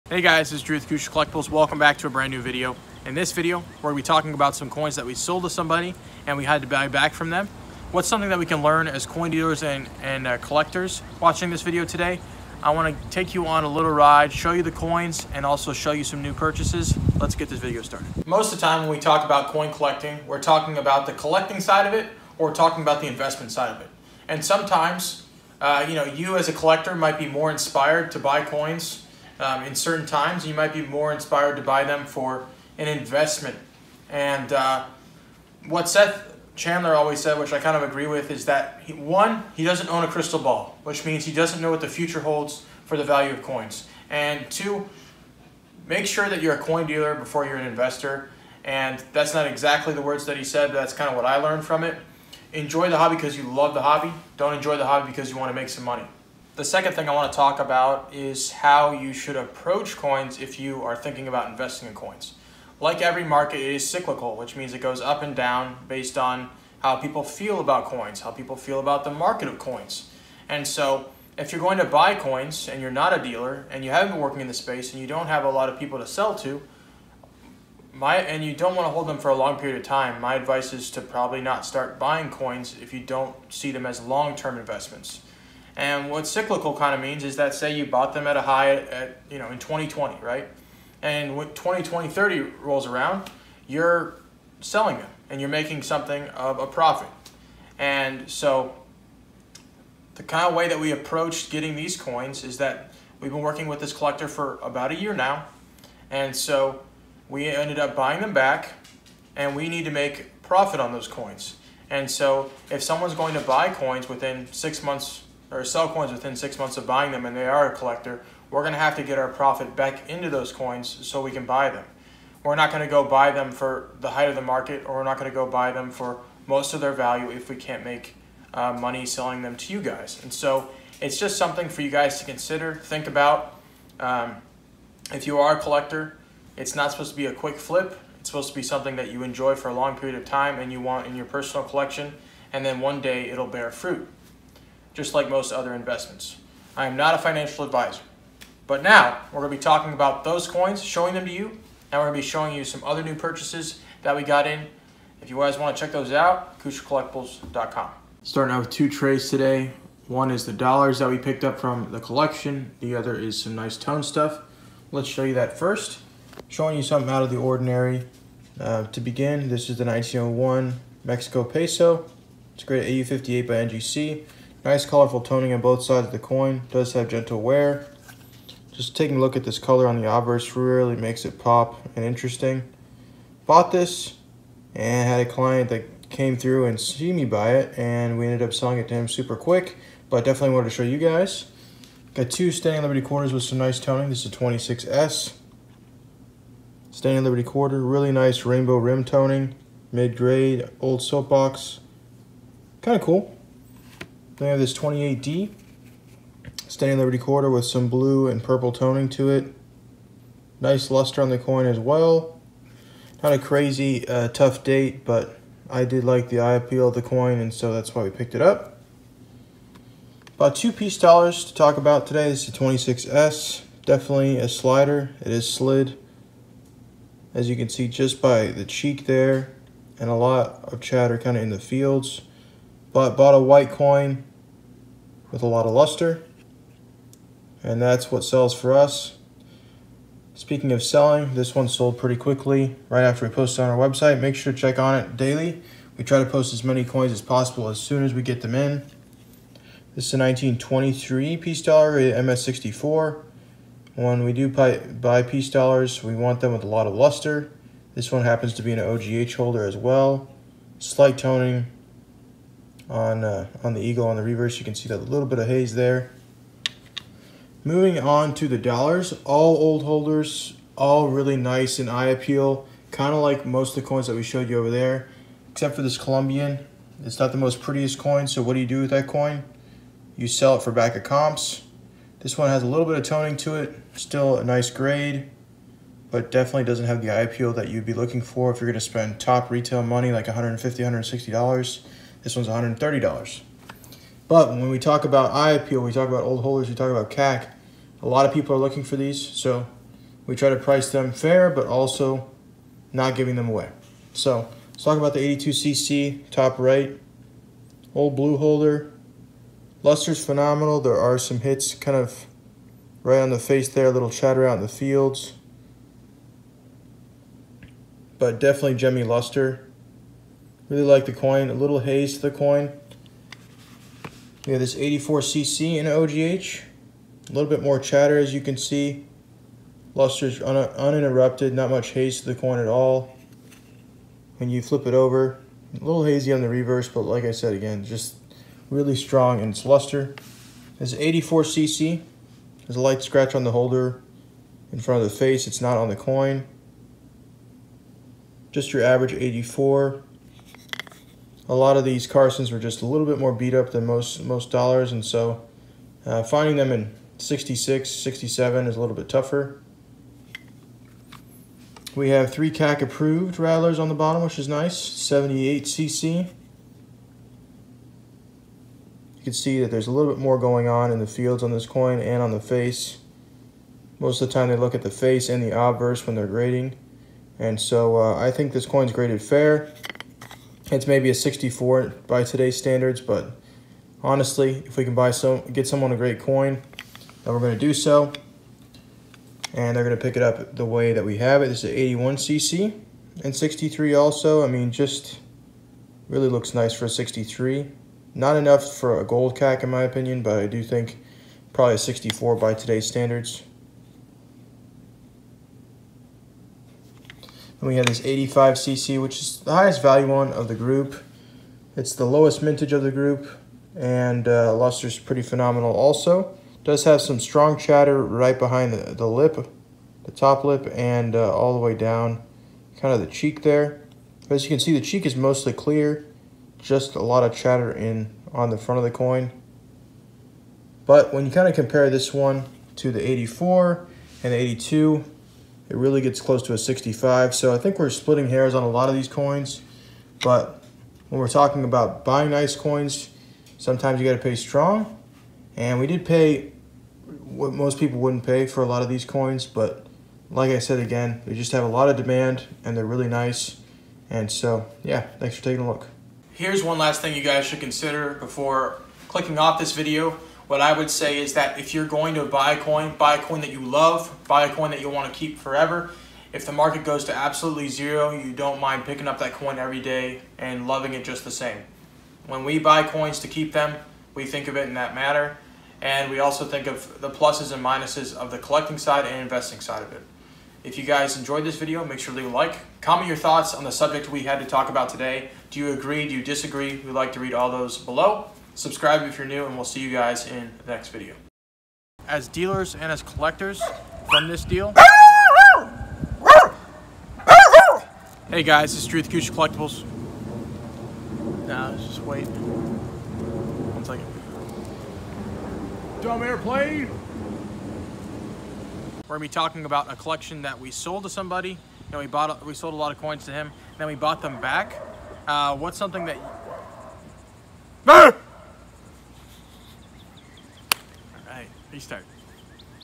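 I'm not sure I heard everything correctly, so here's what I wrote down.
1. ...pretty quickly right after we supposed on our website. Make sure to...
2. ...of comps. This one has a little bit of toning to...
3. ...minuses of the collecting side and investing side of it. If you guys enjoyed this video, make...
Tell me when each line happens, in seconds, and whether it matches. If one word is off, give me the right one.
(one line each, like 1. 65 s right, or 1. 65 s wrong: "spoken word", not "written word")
1. 241 s wrong: "posted", not "supposed"
2. 280 s right
3. 477 s right.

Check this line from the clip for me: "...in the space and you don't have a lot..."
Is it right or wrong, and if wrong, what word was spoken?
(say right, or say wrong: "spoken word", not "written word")
right.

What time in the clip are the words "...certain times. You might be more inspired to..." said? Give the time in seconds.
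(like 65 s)
29 s.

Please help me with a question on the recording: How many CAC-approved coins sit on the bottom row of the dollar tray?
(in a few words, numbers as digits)
3.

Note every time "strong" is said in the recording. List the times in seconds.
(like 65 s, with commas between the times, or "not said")
338 s, 417 s, 444 s.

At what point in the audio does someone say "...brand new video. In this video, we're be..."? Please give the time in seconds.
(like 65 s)
2 s.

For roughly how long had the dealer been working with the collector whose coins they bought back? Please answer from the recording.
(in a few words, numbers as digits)
About a year.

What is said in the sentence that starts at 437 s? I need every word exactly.
So I think we're splitting hairs on a lot of these coins.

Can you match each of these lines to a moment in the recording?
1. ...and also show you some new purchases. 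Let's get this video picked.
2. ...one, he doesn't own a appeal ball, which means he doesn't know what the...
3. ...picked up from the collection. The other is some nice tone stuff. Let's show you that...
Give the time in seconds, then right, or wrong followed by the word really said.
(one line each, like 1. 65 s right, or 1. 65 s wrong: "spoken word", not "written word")
1. 15 s wrong: "started", not "picked"
2. 38 s wrong: "crystal", not "appeal"
3. 161 s right.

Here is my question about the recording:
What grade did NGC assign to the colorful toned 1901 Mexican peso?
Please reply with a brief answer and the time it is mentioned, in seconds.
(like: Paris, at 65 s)
AU58, at 173 s.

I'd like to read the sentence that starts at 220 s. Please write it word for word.
About two Peace dollars to talk about today.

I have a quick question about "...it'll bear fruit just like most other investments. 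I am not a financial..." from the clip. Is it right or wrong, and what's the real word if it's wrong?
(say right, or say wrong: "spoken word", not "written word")
right.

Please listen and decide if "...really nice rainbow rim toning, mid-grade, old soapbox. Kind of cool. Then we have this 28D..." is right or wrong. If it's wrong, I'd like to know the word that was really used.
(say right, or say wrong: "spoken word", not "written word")
right.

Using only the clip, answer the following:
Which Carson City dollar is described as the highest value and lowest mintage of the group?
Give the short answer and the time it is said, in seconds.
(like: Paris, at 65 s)
85cc, at 408 s.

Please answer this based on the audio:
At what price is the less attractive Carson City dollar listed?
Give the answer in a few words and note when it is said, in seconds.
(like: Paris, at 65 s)
$130, at 292 s.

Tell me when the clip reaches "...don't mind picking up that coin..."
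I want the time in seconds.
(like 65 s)
468 s.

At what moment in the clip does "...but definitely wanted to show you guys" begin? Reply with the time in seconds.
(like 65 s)
190 s.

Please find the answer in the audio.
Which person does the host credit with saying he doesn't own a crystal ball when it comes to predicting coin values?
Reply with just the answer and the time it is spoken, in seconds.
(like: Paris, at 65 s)
Seth Chandler, at 35 s.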